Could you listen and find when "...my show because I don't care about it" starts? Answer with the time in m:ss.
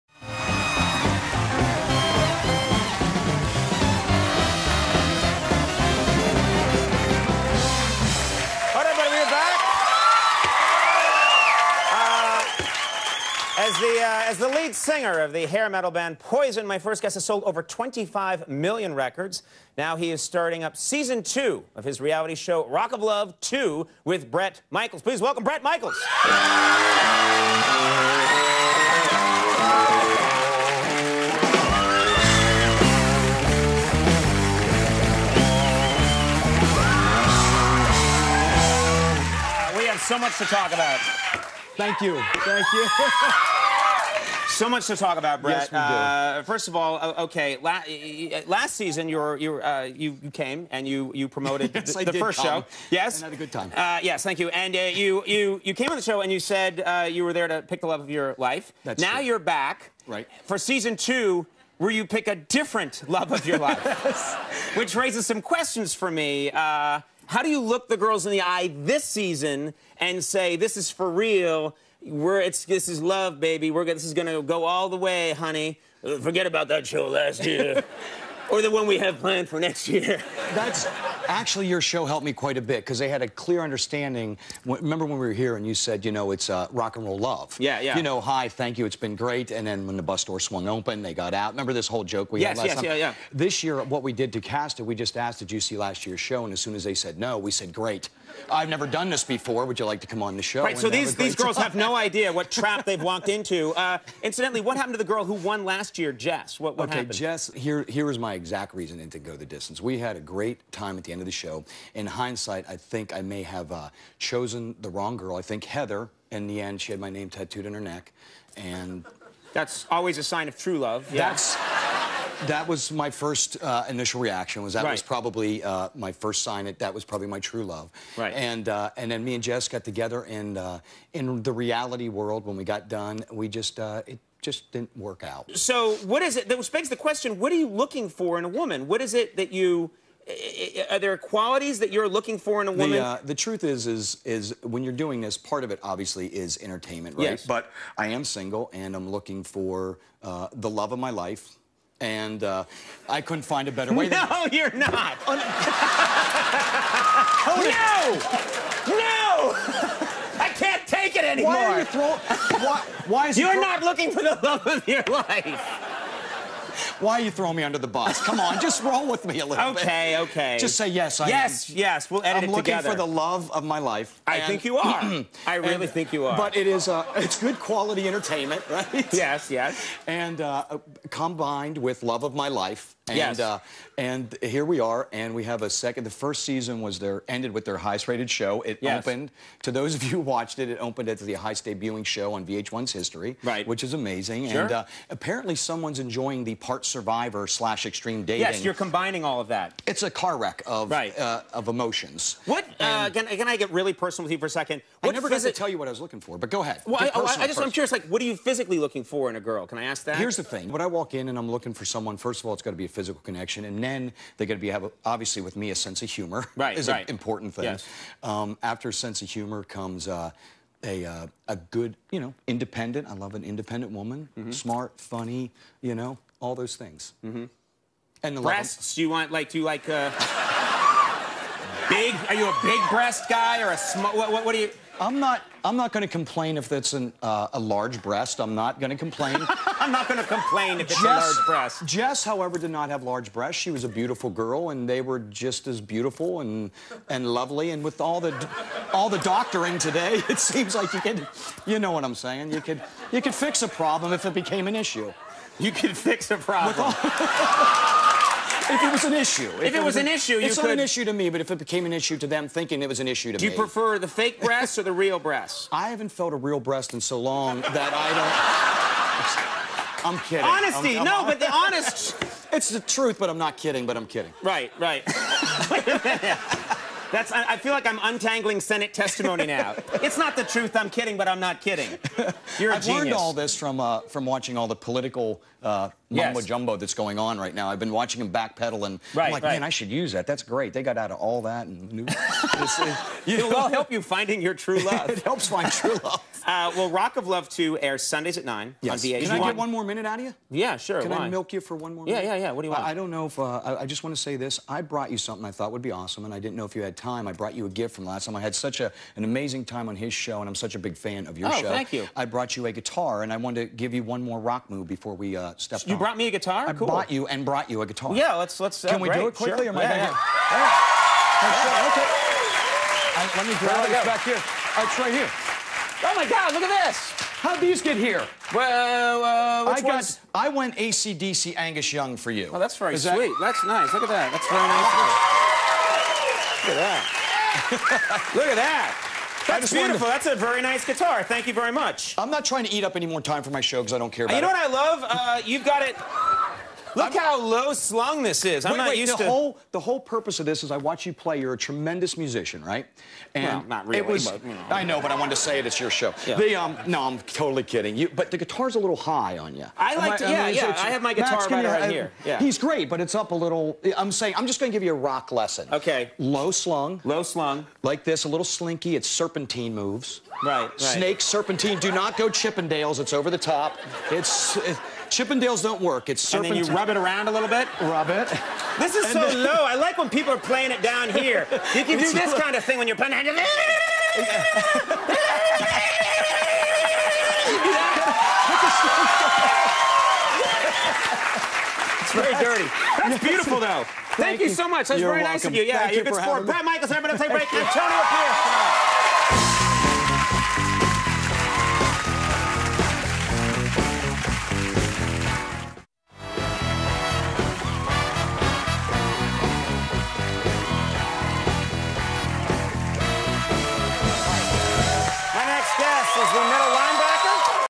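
5:43.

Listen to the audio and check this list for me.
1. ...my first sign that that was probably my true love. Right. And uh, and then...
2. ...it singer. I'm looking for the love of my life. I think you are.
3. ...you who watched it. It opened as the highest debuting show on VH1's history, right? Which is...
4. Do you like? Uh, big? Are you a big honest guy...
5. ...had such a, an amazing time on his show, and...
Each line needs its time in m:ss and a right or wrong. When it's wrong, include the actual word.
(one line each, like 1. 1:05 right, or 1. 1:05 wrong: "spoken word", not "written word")
1. 2:05 right
2. 2:52 wrong: "together", not "singer"
3. 3:10 right
4. 3:49 wrong: "breast", not "honest"
5. 5:08 right.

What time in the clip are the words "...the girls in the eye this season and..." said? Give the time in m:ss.
1:07.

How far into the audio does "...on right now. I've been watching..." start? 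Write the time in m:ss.
4:47.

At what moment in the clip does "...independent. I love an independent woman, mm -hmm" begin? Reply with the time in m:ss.
3:42.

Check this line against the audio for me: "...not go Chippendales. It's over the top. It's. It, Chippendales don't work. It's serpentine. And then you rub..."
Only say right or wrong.
right.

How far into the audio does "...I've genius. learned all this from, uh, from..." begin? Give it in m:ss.
4:42.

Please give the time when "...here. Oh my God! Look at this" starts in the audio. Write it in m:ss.
5:25.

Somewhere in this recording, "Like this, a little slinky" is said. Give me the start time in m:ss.
6:07.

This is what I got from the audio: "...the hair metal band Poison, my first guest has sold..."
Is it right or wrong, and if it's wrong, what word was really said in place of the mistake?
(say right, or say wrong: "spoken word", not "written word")
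right.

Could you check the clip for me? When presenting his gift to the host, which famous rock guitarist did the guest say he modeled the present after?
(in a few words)
Angus Young.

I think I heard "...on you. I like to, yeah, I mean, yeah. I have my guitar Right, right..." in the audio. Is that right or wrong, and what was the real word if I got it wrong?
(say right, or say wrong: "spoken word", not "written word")
wrong: "Max", not "Right".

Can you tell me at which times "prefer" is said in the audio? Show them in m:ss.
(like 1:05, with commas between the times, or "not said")
4:23.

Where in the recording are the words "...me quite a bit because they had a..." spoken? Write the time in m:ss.
1:22.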